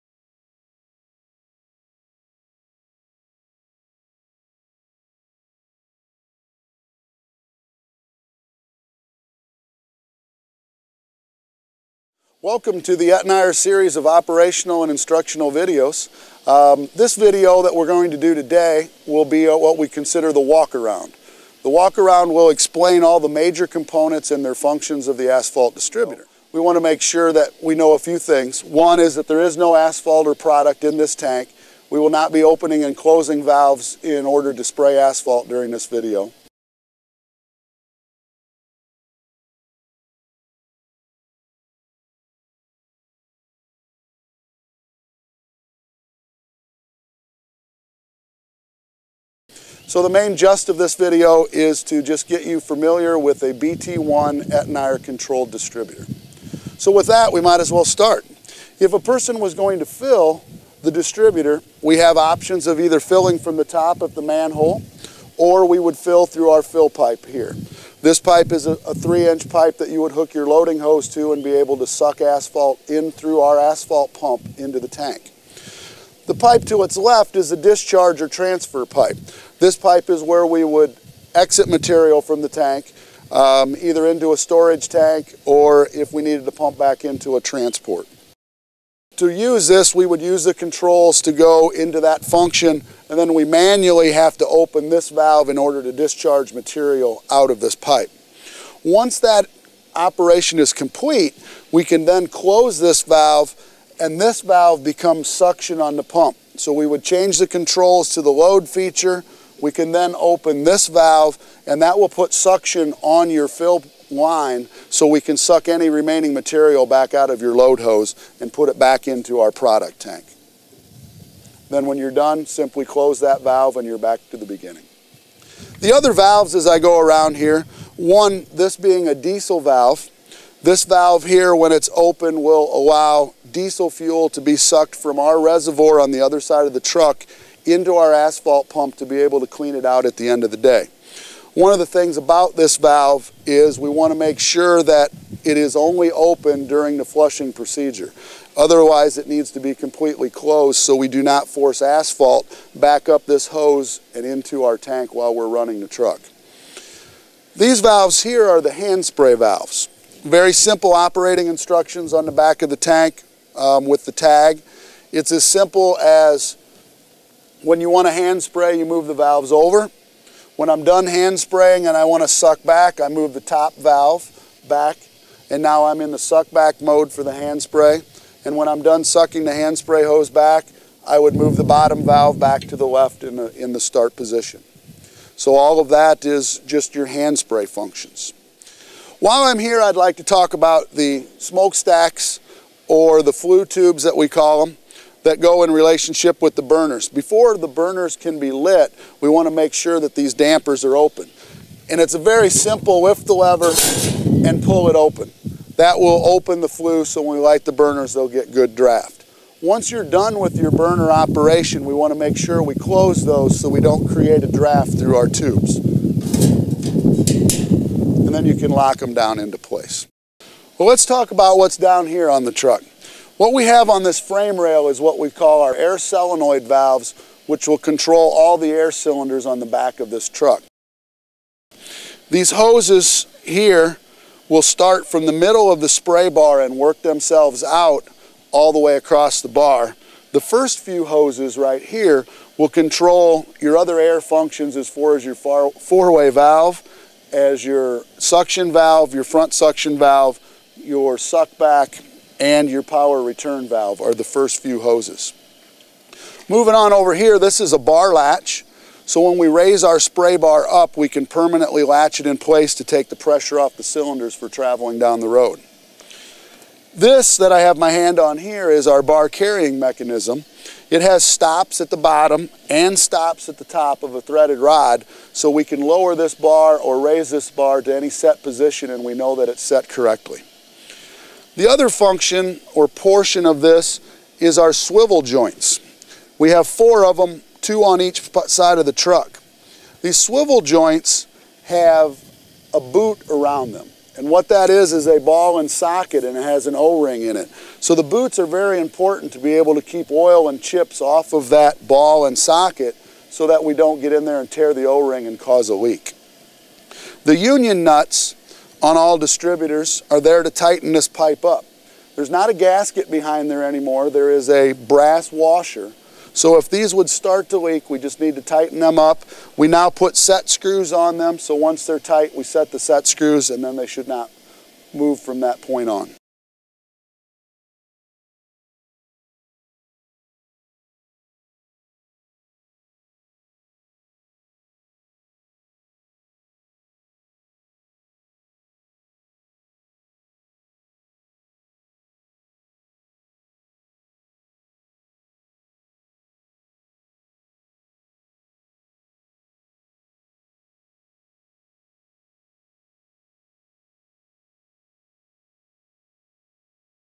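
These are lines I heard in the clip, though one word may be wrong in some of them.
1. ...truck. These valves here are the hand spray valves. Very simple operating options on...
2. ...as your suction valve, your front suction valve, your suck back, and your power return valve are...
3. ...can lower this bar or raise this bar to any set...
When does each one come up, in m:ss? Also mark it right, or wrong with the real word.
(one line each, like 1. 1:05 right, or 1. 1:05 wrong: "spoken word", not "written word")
1. 2:35 wrong: "instructions", not "options"
2. 4:07 right
3. 4:35 right.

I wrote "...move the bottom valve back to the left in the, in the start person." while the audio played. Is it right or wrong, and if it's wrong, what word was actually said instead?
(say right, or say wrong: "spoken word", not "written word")
wrong: "position", not "person".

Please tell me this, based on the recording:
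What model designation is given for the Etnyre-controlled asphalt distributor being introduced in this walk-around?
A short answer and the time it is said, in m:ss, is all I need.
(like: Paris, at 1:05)
BT1, at 0:53.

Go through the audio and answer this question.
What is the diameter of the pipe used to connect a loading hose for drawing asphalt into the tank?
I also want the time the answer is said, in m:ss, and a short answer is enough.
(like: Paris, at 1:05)
3 inch, at 1:08.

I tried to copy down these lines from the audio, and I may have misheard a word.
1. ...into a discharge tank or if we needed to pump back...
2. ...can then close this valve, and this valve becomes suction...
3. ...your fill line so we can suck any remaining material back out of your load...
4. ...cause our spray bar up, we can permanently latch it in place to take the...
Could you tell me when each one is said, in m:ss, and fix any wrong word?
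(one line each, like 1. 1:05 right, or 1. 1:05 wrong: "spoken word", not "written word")
1. 1:24 wrong: "storage", not "discharge"
2. 1:41 right
3. 1:53 right
4. 4:19 wrong: "raise", not "cause".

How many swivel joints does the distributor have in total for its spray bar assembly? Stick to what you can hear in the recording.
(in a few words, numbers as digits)
4.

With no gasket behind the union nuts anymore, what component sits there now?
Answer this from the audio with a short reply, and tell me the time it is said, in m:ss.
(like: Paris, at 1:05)
Brass washer, at 5:14.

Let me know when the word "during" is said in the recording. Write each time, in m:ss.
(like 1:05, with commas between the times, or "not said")
0:35, 2:26.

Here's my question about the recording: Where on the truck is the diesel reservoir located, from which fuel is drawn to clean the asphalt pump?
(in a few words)
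Other side of the truck.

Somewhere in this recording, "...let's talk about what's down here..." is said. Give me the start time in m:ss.
3:40.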